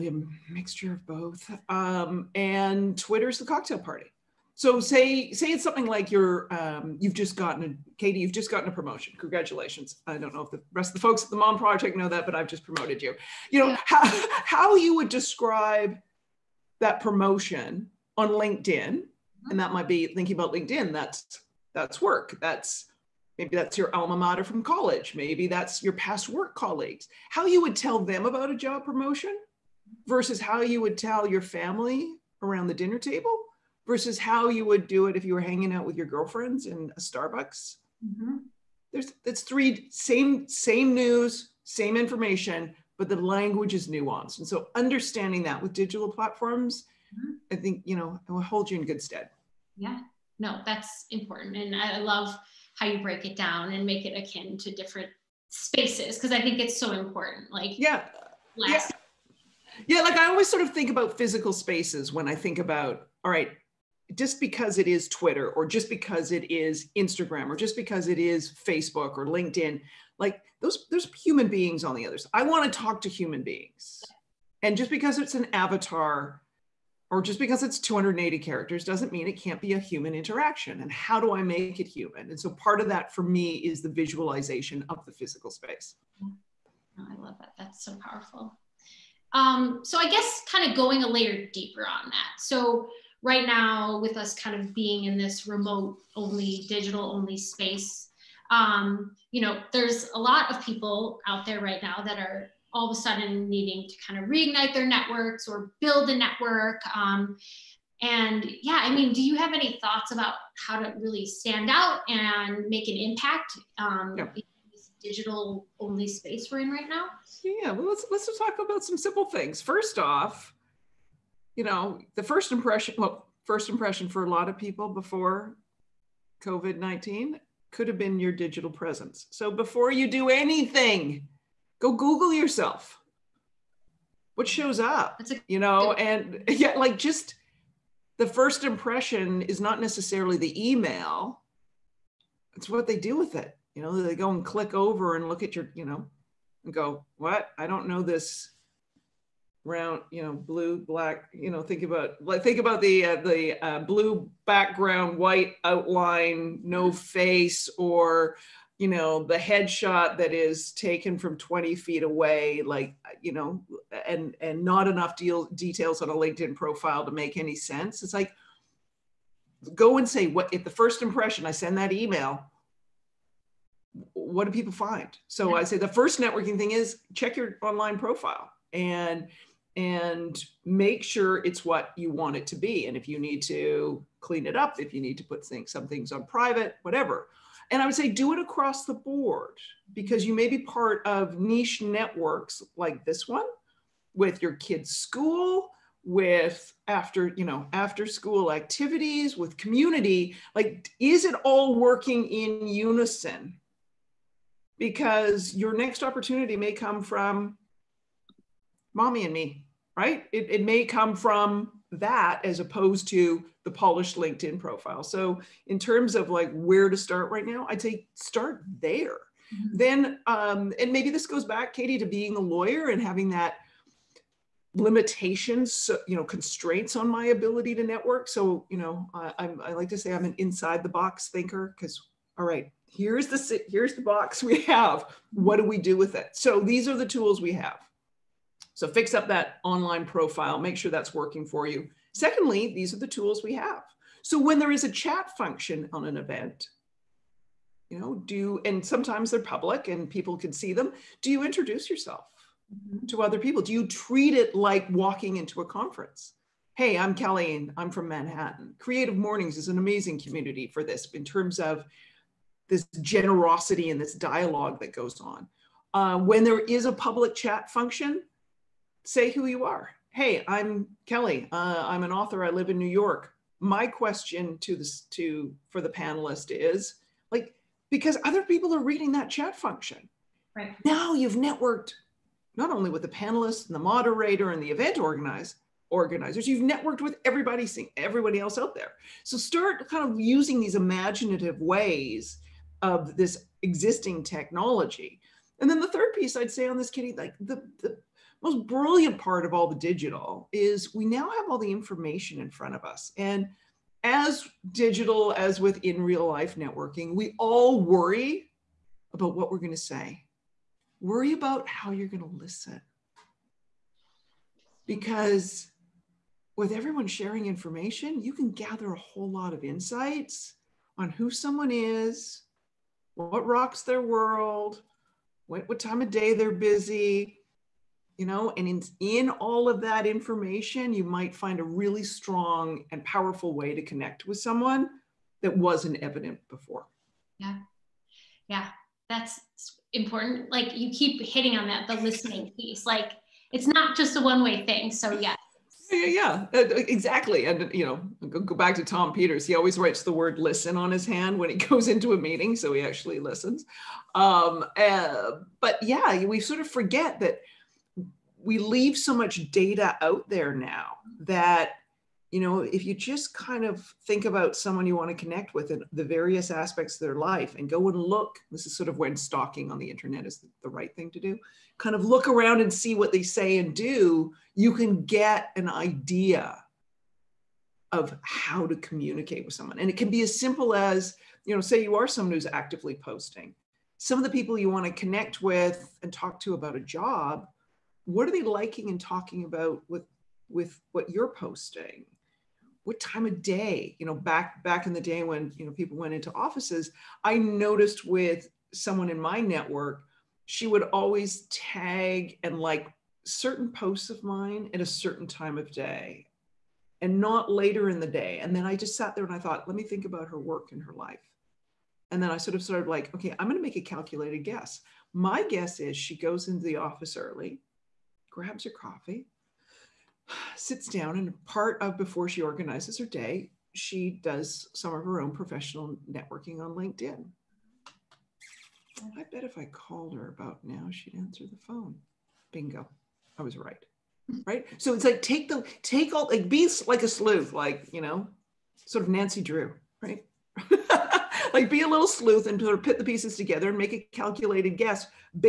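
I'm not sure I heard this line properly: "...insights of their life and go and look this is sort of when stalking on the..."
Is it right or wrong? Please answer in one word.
wrong.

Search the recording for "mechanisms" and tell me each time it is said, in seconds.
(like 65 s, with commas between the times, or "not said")
not said.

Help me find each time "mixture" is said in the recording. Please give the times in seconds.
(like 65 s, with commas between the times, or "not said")
0 s.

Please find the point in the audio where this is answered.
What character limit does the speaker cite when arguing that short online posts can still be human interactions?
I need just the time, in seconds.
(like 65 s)
77 s.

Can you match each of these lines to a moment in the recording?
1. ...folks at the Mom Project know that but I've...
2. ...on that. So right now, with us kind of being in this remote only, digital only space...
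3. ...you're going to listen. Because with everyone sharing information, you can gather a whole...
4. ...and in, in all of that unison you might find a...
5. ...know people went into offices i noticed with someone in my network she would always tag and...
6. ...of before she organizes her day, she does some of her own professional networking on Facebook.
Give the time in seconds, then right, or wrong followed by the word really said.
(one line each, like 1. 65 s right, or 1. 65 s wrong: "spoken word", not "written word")
1. 11 s right
2. 91 s right
3. 311 s right
4. 328 s wrong: "information", not "unison"
5. 395 s right
6. 421 s wrong: "LinkedIn", not "Facebook".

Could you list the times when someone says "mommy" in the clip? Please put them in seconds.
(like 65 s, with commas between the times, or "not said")
208 s.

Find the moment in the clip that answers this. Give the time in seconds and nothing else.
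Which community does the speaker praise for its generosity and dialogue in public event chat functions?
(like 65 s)
258 s.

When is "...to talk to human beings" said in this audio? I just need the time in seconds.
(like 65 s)
72 s.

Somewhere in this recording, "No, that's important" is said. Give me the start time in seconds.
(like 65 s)
50 s.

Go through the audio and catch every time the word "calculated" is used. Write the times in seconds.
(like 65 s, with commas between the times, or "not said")
413 s, 444 s.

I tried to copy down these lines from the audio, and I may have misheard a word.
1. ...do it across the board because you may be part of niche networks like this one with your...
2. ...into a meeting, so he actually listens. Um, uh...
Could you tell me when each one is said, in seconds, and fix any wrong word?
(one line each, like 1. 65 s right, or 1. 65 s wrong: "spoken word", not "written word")
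1. 188 s right
2. 351 s right.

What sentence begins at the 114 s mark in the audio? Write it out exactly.
in this digital only space we're in right now?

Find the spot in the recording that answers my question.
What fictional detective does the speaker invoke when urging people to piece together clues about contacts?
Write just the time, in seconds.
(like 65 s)
439 s.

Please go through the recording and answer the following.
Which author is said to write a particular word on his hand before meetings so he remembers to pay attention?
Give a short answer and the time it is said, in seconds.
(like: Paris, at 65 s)
Tom Peters, at 348 s.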